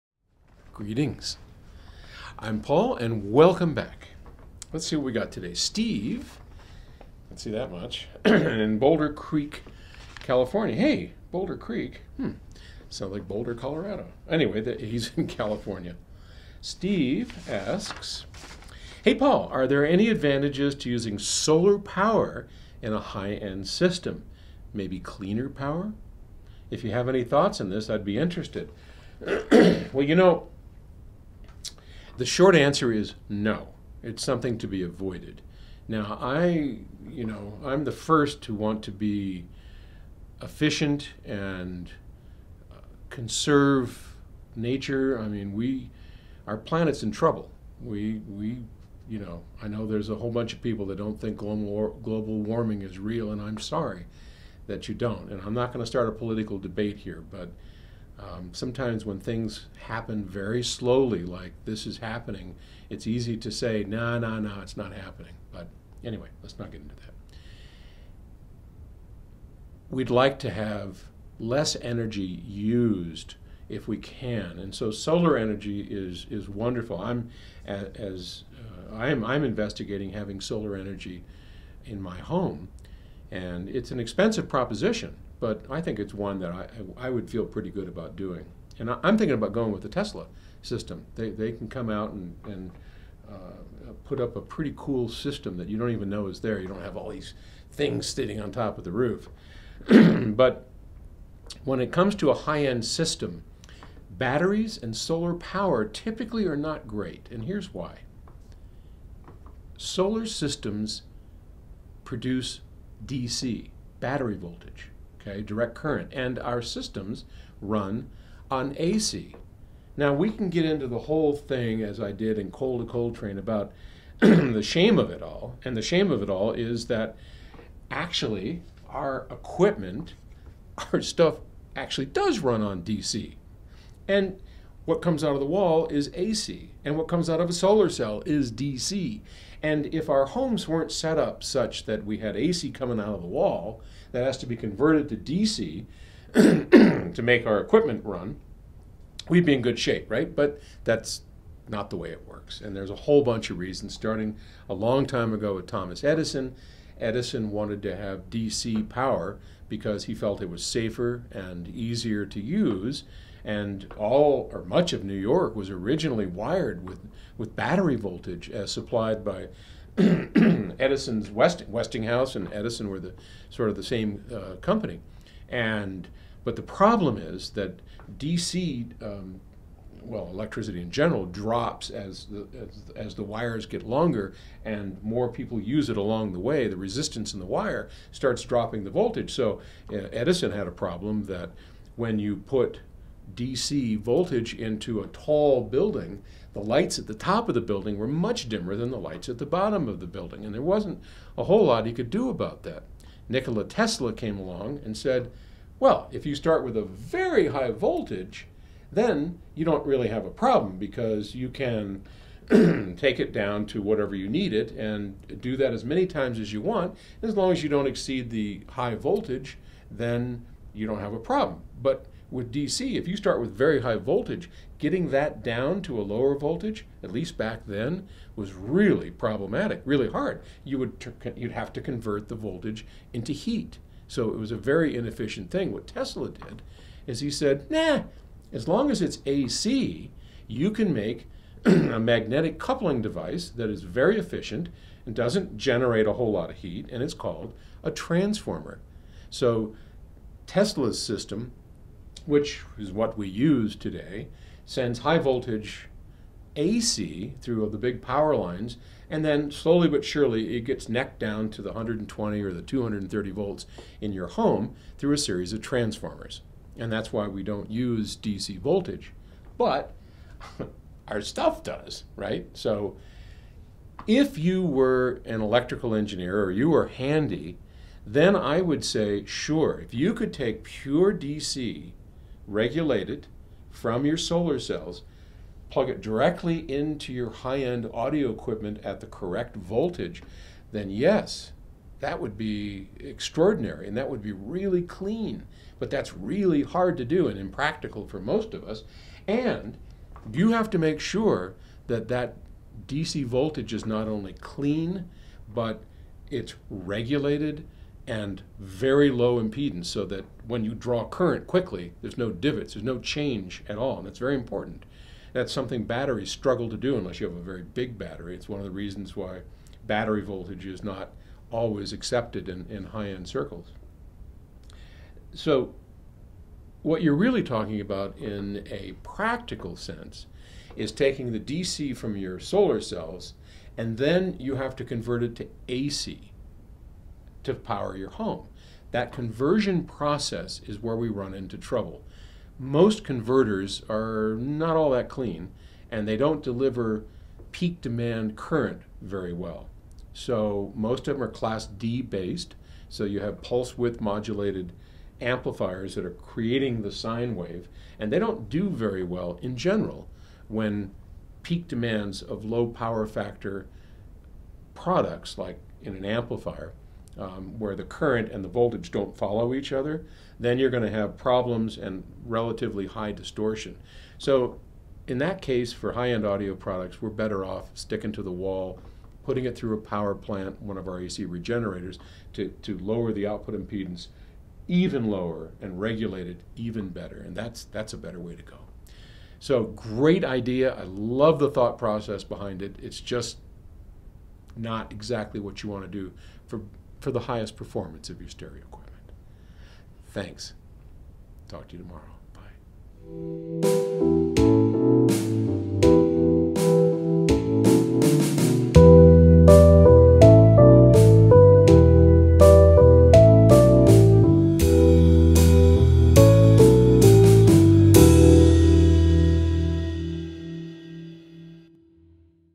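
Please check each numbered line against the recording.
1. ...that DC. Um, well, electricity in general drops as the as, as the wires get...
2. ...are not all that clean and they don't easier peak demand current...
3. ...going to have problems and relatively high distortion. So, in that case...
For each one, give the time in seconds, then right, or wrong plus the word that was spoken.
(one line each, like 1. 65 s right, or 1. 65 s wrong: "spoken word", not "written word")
1. 177 s right
2. 343 s wrong: "deliver", not "easier"
3. 370 s right.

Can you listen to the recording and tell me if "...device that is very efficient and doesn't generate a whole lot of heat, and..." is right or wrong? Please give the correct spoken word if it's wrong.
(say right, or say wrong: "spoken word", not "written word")
right.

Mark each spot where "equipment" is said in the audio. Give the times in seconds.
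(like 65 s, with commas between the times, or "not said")
129 s, 147 s, 288 s, 398 s.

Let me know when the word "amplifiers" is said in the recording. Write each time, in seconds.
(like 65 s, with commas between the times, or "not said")
355 s, 366 s.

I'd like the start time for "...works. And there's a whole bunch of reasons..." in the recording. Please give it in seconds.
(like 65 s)
152 s.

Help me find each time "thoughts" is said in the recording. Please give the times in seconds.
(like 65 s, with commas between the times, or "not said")
27 s, 391 s.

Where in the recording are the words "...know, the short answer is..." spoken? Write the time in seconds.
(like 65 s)
30 s.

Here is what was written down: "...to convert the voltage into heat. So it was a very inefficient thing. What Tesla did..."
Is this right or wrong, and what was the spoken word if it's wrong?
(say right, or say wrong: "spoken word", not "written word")
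right.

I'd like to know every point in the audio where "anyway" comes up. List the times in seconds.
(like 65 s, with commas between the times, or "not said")
14 s, 66 s.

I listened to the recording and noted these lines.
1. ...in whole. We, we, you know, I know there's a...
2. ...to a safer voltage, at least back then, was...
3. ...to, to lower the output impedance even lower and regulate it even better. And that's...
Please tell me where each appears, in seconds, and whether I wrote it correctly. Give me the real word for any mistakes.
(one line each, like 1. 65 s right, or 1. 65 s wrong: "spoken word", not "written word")
1. 47 s wrong: "trouble", not "whole"
2. 225 s wrong: "lower", not "safer"
3. 382 s right.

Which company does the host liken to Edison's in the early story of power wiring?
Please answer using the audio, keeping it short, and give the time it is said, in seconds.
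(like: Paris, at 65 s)
Westinghouse, at 171 s.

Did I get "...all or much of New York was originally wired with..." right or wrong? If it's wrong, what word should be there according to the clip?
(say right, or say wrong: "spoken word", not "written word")
right.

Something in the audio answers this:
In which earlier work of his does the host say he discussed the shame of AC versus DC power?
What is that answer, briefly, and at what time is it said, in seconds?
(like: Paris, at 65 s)
Coal to Train, at 122 s.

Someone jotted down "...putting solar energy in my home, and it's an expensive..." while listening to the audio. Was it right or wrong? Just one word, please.
wrong.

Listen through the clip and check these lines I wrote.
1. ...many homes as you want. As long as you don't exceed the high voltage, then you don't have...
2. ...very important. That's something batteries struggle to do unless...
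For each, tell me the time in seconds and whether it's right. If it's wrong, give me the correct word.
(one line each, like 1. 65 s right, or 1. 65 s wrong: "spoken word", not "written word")
1. 215 s wrong: "times", not "homes"
2. 314 s right.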